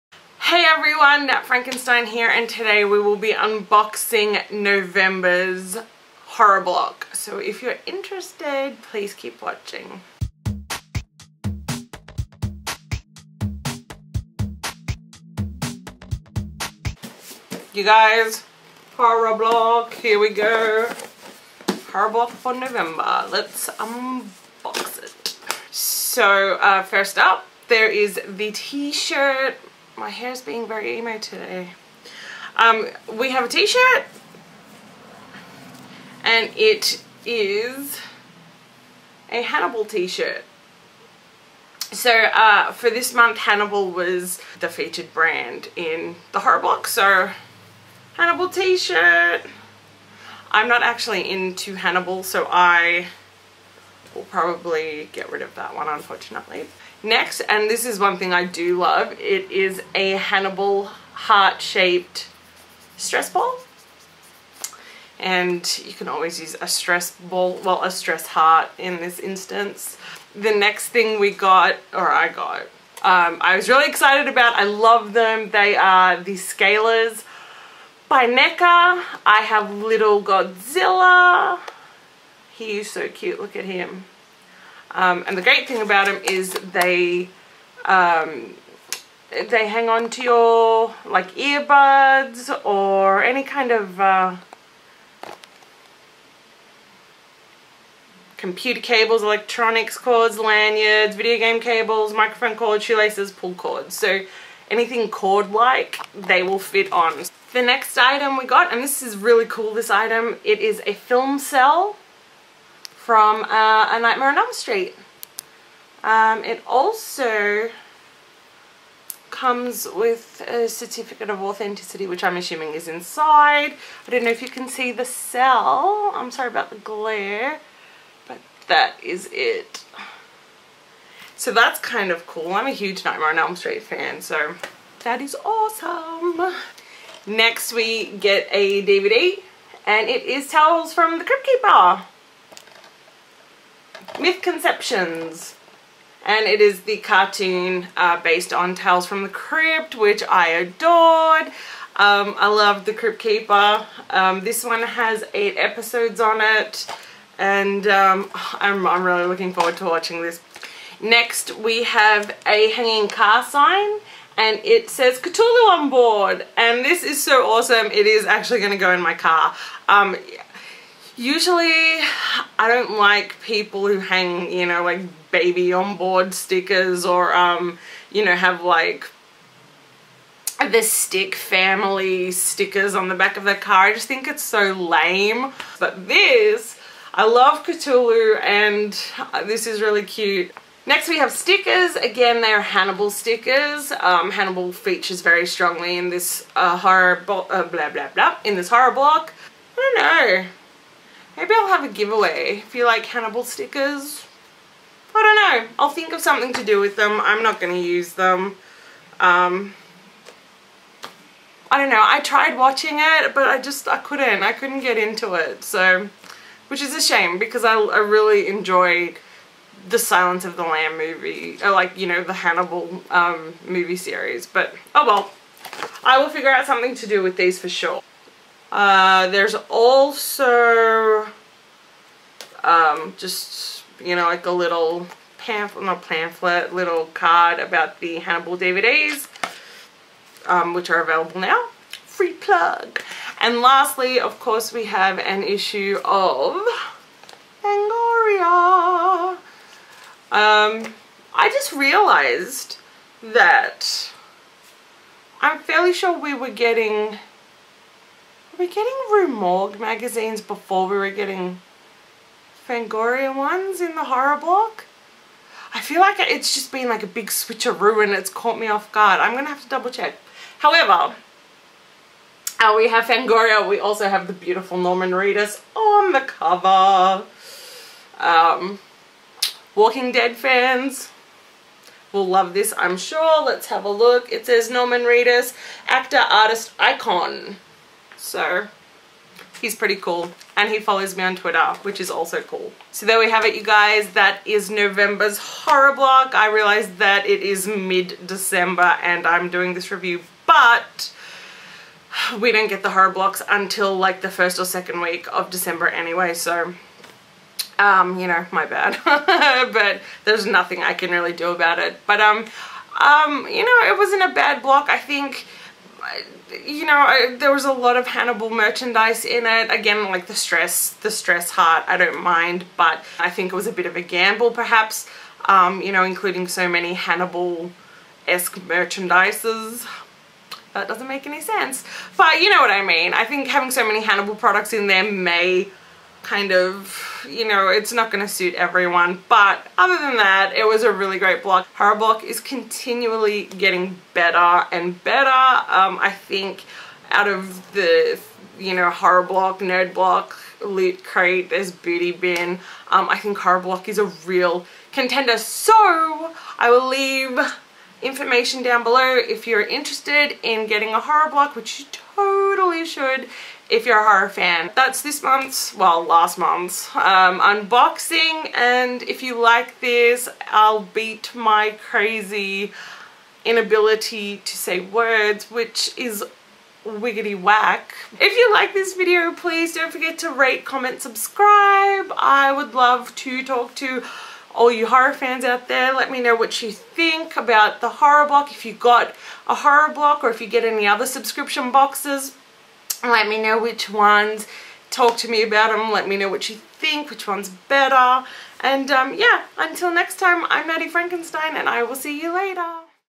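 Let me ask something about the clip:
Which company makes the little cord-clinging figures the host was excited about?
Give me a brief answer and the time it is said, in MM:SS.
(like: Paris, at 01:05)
NECA, at 01:18.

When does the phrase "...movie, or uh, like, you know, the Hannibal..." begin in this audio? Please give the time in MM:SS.
03:40.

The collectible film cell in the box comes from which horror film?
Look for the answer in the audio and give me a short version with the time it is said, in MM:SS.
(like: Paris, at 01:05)
A Nightmare on Elm Street, at 01:53.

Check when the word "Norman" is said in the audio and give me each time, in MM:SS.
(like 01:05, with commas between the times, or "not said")
04:34, 04:44.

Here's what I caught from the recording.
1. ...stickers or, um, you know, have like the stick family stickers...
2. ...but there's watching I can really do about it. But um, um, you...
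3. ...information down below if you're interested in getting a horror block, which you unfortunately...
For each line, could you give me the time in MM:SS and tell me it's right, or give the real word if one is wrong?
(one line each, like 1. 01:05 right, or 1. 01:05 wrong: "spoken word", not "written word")
1. 02:56 right
2. 05:09 wrong: "nothing", not "watching"
3. 05:58 wrong: "totally", not "unfortunately".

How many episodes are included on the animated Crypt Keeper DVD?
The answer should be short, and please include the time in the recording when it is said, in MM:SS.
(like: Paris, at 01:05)
8, at 02:35.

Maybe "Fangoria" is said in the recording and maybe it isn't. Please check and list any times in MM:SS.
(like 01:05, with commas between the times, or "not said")
04:07, 04:22, 04:33.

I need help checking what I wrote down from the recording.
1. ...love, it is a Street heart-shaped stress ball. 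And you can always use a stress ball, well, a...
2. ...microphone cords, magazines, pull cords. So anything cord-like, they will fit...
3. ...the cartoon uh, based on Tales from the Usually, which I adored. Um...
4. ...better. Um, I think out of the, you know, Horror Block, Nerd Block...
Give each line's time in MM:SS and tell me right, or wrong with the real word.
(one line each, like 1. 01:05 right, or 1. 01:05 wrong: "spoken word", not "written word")
1. 00:58 wrong: "Hannibal", not "Street"
2. 01:42 wrong: "shoelaces", not "magazines"
3. 02:26 wrong: "Crypt", not "Usually"
4. 05:45 right.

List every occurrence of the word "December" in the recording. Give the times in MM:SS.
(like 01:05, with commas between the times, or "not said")
04:57, 05:05.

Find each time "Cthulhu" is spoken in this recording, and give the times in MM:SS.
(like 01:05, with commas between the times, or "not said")
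02:45, 03:07.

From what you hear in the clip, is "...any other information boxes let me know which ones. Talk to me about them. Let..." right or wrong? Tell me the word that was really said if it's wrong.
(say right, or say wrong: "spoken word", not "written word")
wrong: "subscription", not "information".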